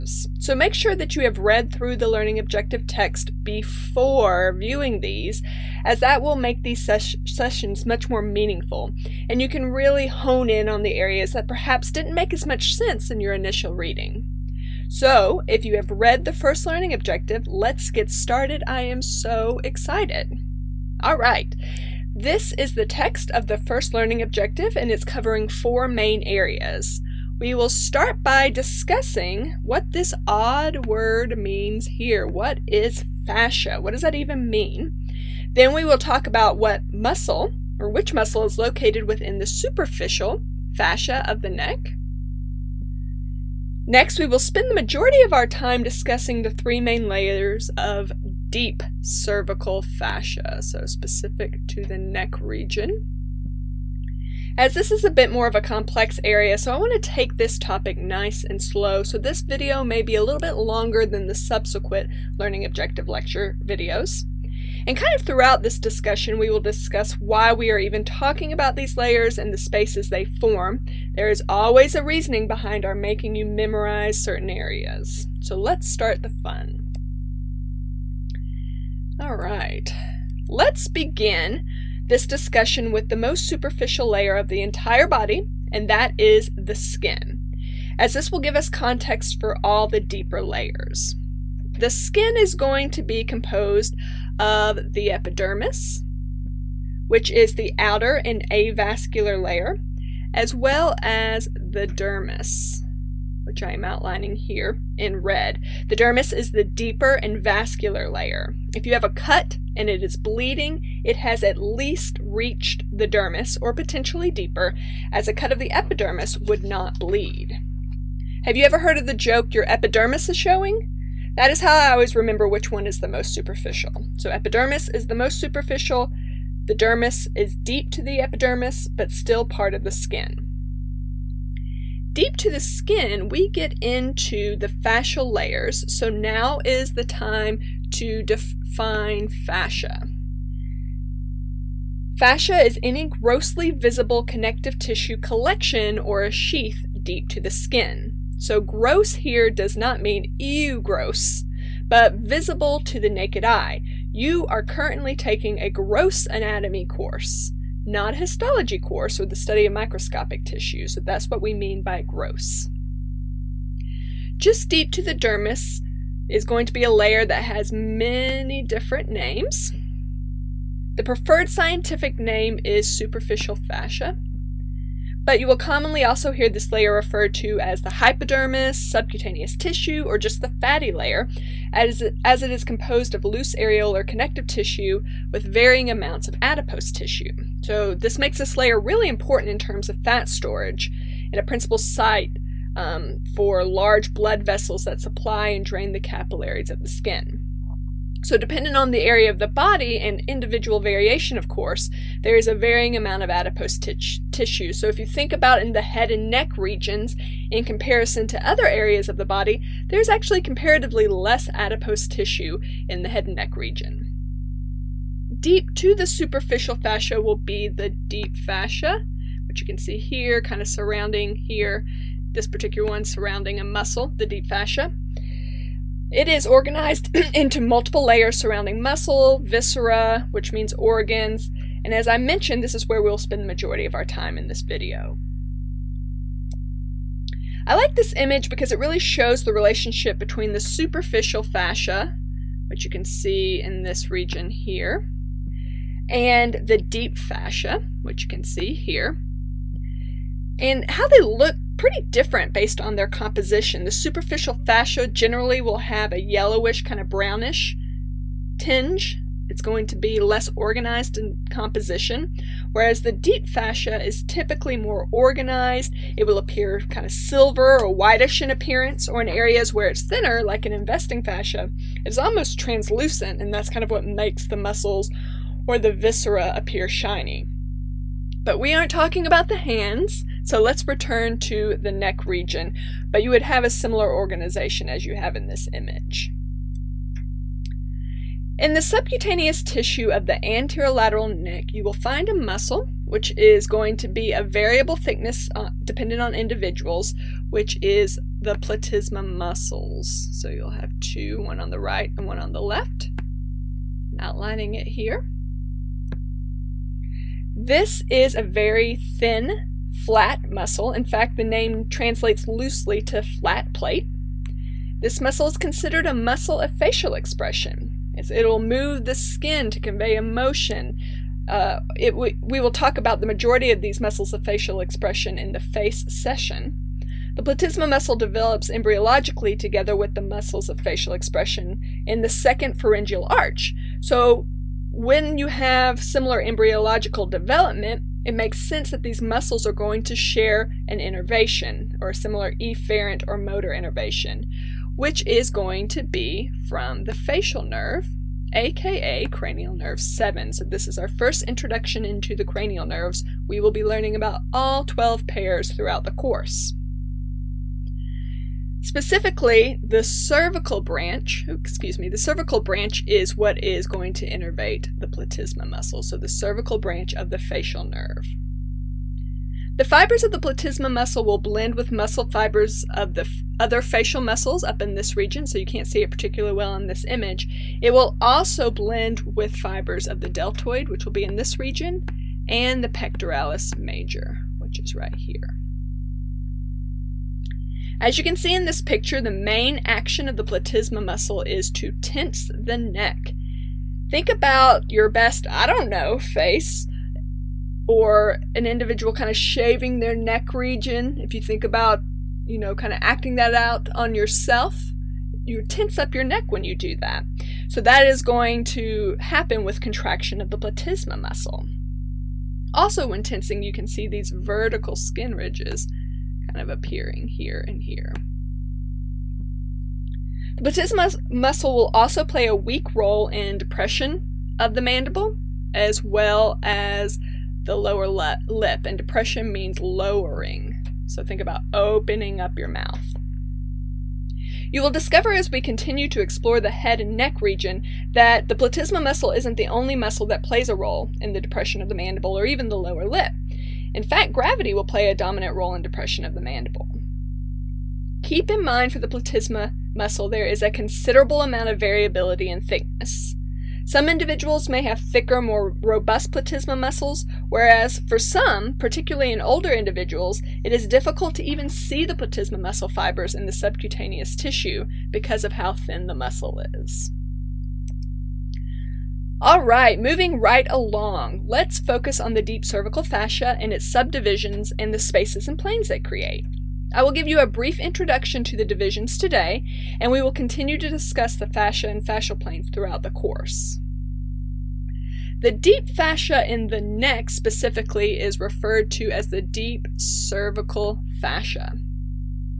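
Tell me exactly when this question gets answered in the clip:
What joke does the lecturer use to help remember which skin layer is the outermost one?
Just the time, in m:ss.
1:59.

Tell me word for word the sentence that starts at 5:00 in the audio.
So you'll have two, one on the right and one on the left.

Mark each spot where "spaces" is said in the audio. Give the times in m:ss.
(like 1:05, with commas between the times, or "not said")
1:09, 7:54.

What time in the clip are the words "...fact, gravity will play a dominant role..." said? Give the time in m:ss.
7:24.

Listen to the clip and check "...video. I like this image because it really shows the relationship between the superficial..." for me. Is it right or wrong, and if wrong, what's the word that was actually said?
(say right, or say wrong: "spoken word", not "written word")
right.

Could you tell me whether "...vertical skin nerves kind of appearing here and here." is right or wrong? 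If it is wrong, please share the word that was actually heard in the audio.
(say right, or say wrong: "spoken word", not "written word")
wrong: "ridges", not "nerves".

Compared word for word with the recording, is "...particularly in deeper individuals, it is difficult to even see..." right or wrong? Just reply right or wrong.
wrong.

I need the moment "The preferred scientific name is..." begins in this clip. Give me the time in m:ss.
2:50.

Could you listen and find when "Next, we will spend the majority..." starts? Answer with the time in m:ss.
0:43.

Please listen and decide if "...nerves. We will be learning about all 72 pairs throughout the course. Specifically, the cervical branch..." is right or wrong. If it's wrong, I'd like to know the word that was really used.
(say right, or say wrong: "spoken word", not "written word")
wrong: "12", not "72".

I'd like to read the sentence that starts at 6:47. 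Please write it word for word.
So that is going to happen with contraction of the platysma muscle.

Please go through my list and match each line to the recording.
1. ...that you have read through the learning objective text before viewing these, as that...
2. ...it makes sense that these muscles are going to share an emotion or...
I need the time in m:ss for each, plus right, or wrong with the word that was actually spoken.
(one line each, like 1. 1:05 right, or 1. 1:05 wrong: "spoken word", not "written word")
1. 0:00 right
2. 5:38 wrong: "innervation", not "emotion".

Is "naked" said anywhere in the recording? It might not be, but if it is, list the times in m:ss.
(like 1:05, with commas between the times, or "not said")
2:33.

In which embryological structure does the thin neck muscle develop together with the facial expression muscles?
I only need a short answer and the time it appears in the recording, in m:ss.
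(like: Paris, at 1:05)
Second pharyngeal arch, at 5:32.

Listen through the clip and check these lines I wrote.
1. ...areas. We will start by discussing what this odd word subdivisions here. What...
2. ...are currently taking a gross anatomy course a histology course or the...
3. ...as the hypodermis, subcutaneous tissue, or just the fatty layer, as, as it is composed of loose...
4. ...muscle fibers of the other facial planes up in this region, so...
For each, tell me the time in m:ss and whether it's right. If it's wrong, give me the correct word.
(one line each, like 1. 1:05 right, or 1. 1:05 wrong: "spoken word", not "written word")
1. 0:26 wrong: "means", not "subdivisions"
2. 2:34 right
3. 2:57 right
4. 6:11 wrong: "muscles", not "planes".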